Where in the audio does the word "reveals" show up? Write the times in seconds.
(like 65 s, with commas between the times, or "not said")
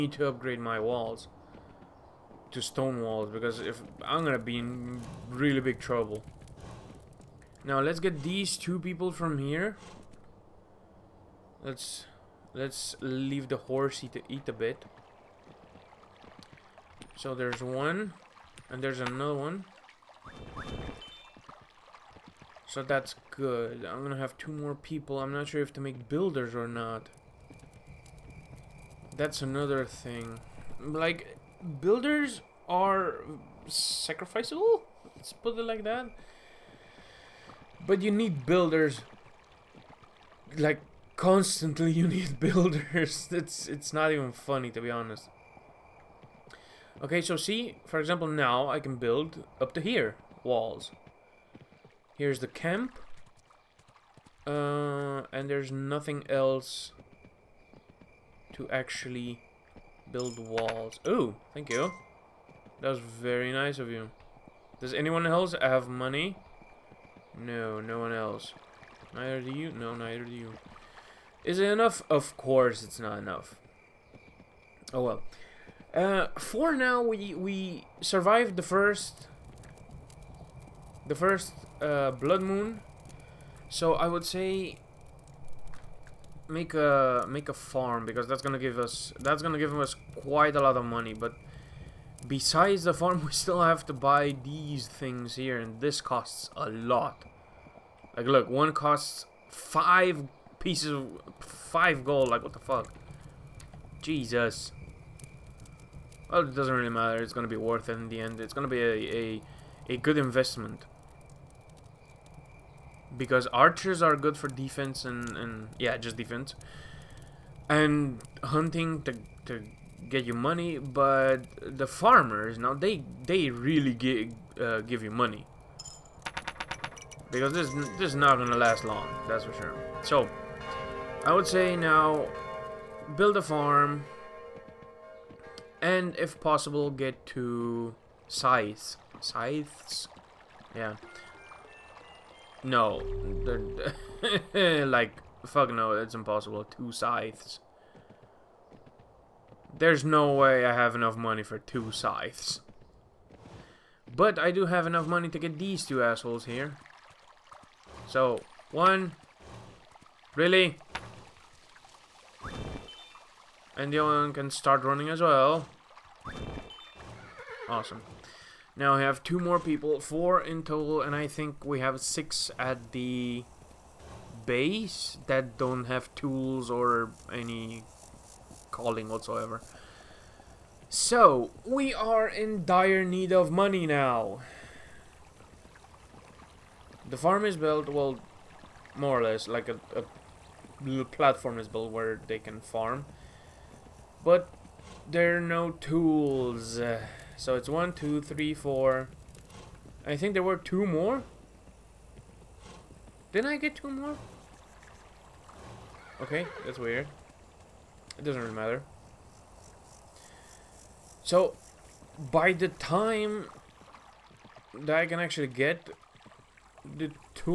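not said.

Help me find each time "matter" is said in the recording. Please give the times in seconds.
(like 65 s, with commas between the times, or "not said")
106 s, 208 s.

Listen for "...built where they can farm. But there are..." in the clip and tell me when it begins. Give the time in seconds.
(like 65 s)
191 s.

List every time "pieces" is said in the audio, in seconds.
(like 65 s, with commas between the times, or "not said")
100 s.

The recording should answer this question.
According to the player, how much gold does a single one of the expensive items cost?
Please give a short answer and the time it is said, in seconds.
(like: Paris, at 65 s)
5 gold, at 101 s.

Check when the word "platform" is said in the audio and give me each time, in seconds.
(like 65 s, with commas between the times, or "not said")
191 s.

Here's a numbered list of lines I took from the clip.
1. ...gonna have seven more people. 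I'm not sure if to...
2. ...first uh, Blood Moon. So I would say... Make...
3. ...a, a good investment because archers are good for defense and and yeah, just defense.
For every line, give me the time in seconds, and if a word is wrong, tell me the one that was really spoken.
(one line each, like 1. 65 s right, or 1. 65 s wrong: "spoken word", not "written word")
1. 24 s wrong: "two", not "seven"
2. 81 s right
3. 109 s right.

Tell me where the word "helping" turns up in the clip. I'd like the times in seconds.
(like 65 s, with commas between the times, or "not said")
not said.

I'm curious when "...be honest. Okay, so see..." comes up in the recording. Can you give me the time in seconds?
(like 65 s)
44 s.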